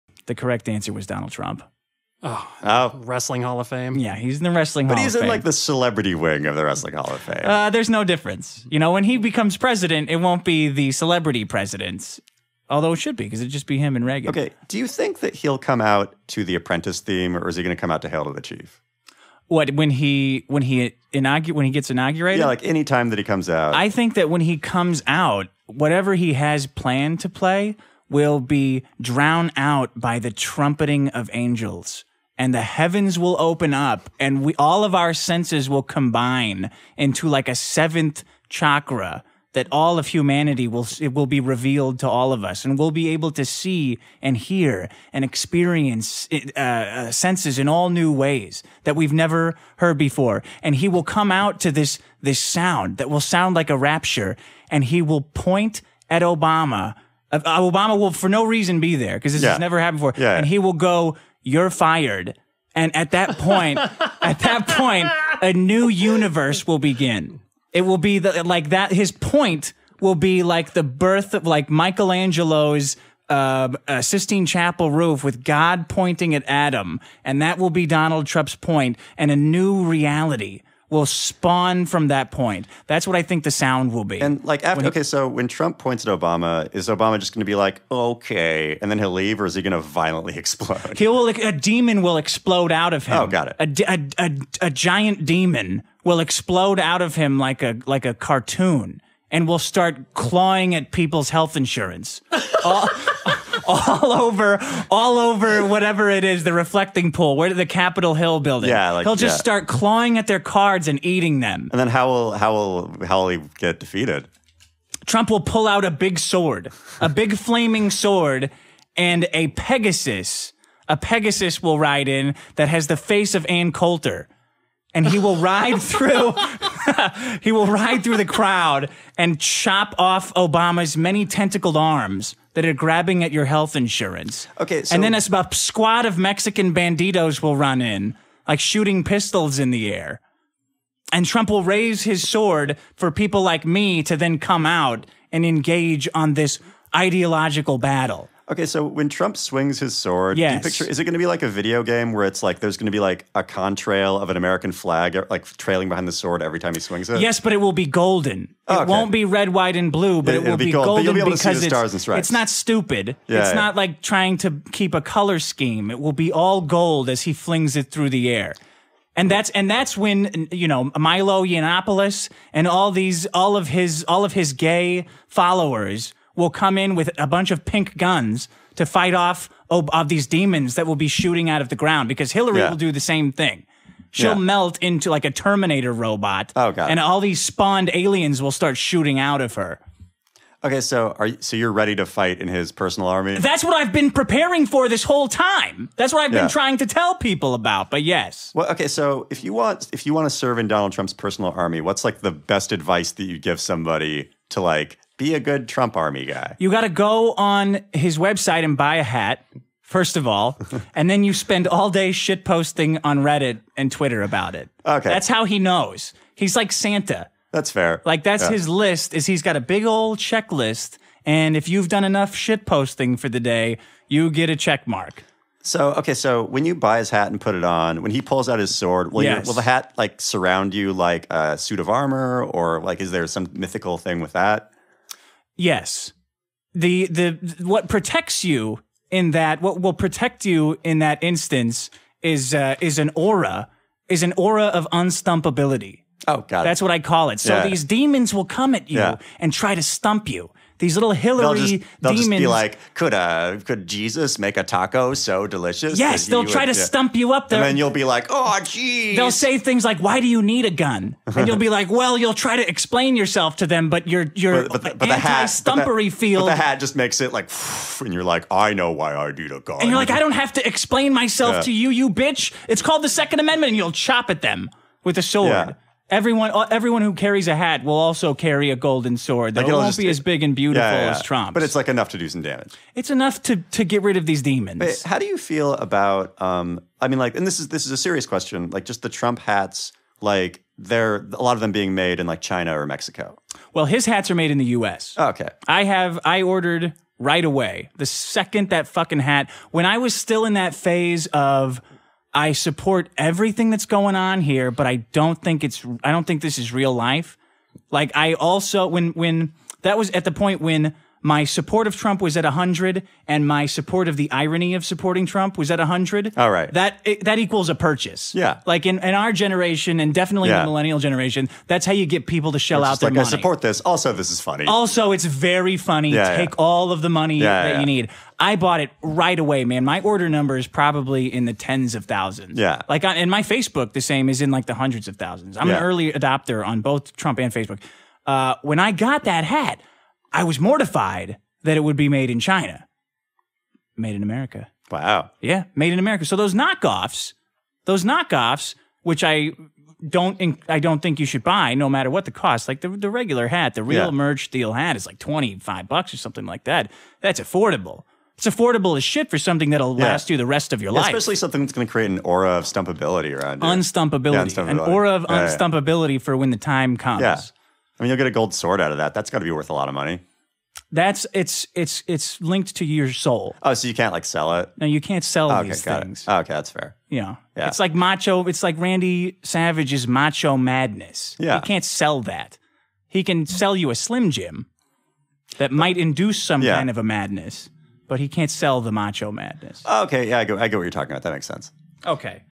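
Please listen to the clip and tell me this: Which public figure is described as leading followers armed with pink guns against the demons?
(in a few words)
Milo Yiannopoulos.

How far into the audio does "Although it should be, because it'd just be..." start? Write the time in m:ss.
0:12.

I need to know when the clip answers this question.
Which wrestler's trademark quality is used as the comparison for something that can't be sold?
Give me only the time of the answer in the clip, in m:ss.
6:18.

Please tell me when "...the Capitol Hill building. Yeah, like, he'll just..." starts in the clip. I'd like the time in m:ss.
1:47.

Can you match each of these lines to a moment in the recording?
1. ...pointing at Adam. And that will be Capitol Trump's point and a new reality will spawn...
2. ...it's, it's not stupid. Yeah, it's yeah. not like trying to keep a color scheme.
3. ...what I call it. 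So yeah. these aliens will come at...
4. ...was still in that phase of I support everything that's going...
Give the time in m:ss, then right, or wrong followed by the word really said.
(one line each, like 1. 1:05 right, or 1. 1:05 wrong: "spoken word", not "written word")
1. 1:15 wrong: "Donald", not "Capitol"
2. 2:41 right
3. 4:06 wrong: "demons", not "aliens"
4. 4:59 right.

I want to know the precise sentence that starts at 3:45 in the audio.
So okay, so when you buy his hat and put it on, when he pulls out his sword, will, yes.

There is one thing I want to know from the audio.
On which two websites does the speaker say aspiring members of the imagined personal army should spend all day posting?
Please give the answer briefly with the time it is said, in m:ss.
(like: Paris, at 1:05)
Reddit and Twitter, at 3:33.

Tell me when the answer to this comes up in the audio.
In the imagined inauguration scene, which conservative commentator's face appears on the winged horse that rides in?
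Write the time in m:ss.
2:03.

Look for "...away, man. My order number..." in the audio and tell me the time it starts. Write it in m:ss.
5:29.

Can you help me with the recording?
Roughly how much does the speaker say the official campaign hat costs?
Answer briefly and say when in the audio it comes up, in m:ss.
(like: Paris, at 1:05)
$25, at 5:55.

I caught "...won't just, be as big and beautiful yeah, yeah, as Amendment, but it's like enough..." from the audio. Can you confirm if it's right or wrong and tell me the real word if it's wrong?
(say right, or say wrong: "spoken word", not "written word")
wrong: "Trump", not "Amendment".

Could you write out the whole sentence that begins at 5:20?
the millennial generation, that's how you get people to shell out their like, money.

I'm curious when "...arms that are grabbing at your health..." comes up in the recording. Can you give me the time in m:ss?
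2:11.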